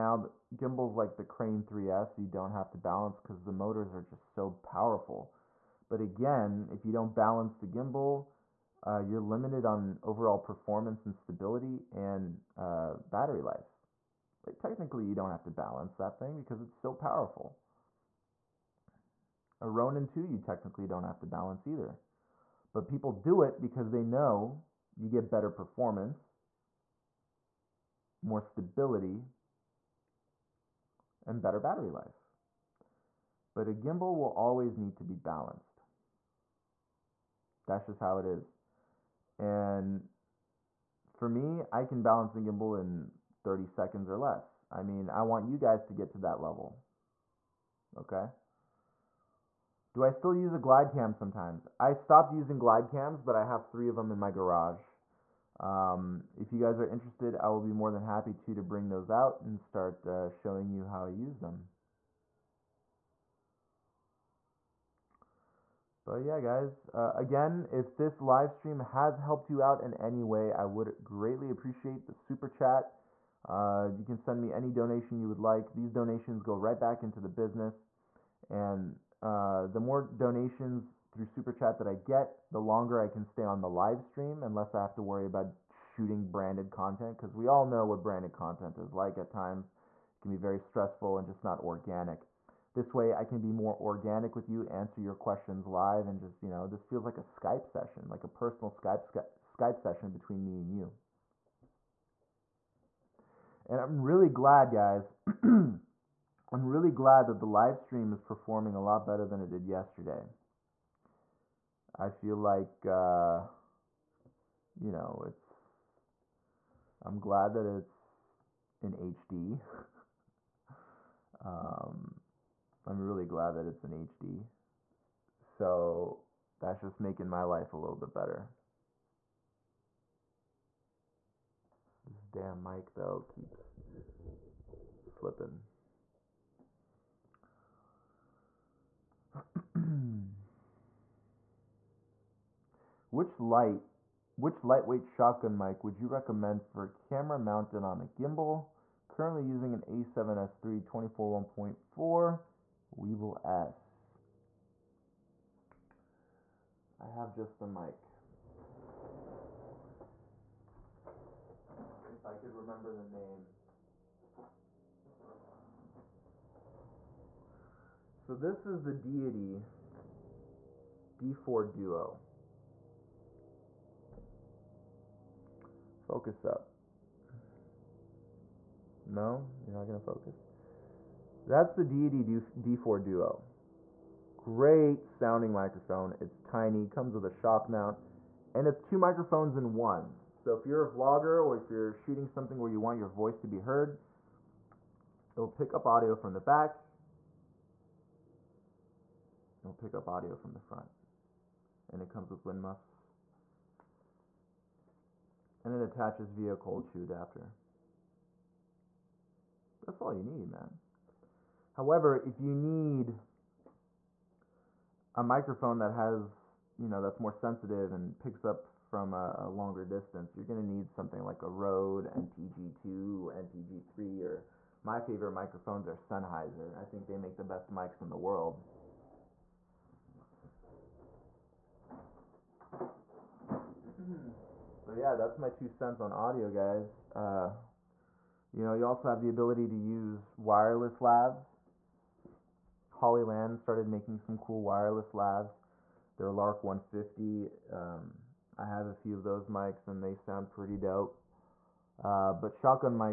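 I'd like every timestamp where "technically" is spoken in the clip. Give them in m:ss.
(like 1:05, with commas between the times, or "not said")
0:14, 0:20.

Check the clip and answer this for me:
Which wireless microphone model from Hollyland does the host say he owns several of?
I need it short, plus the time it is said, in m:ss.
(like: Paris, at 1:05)
Lark 150, at 4:06.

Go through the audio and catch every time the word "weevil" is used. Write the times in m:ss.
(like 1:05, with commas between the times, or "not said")
not said.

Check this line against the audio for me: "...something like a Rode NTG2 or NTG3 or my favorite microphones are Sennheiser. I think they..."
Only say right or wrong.
right.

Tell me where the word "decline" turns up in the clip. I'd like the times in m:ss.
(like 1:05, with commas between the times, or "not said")
not said.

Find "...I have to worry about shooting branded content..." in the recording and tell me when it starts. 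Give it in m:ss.
1:24.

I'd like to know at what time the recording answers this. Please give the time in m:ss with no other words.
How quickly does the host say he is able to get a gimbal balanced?
0:43.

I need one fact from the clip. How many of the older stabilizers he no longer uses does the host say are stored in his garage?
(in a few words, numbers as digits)
3.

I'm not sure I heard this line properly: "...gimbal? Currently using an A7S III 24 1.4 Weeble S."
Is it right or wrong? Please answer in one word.
right.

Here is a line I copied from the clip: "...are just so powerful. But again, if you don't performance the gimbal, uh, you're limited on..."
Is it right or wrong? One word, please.
wrong.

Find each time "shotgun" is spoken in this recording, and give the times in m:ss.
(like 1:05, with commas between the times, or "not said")
2:25, 4:12.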